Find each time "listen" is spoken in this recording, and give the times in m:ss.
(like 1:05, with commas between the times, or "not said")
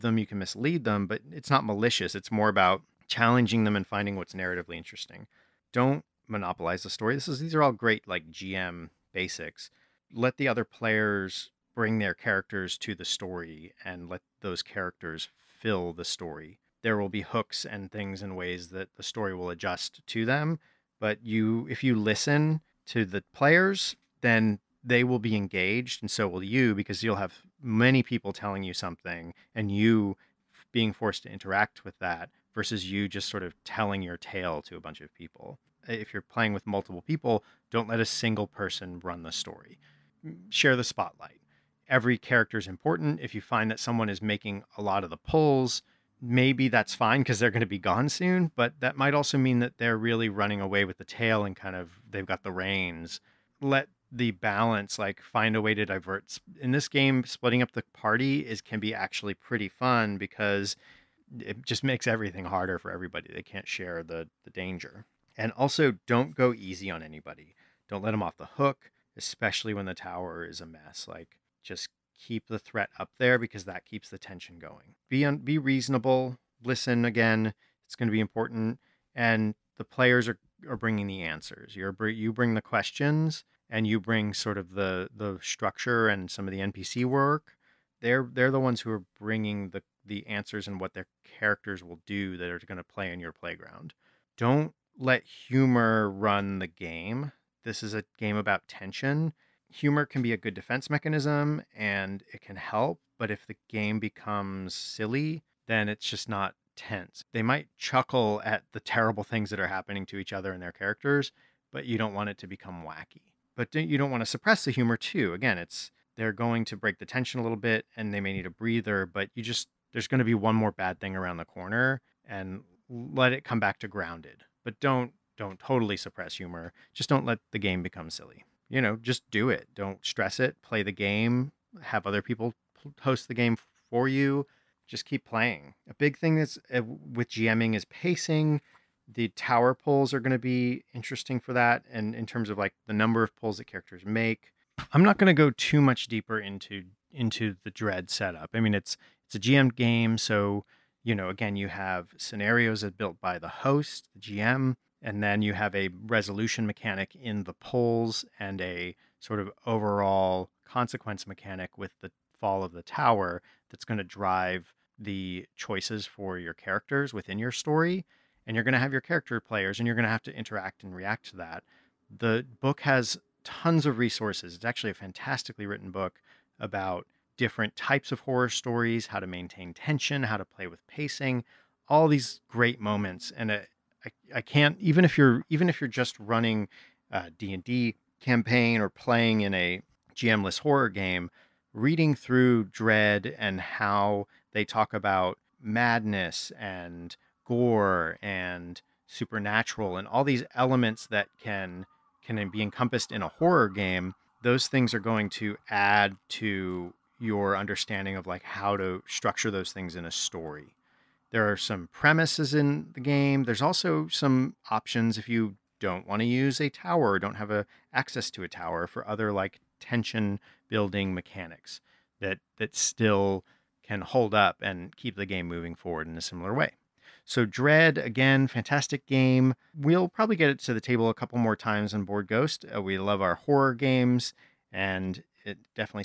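0:21, 1:16.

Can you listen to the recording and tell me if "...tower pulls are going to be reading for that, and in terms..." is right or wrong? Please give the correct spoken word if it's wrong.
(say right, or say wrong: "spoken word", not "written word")
wrong: "interesting", not "reading".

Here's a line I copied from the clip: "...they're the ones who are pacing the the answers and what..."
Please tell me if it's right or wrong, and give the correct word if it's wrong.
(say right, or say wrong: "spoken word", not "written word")
wrong: "bringing", not "pacing".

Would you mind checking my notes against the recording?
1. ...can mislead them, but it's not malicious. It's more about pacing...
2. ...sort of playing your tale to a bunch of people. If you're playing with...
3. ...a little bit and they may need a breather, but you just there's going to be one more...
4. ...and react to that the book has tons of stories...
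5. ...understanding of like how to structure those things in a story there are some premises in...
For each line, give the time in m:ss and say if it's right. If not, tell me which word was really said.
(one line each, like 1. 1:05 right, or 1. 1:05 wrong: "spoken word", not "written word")
1. 0:00 wrong: "challenging", not "pacing"
2. 0:33 wrong: "telling", not "playing"
3. 1:57 right
4. 2:50 wrong: "resources", not "stories"
5. 3:27 right.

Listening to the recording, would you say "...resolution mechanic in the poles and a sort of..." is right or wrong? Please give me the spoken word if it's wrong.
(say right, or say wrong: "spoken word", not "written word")
right.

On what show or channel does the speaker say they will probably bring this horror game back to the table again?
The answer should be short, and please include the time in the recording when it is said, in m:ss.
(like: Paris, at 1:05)
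Bored Ghost, at 3:52.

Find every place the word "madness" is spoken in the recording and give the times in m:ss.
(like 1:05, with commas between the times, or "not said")
3:15.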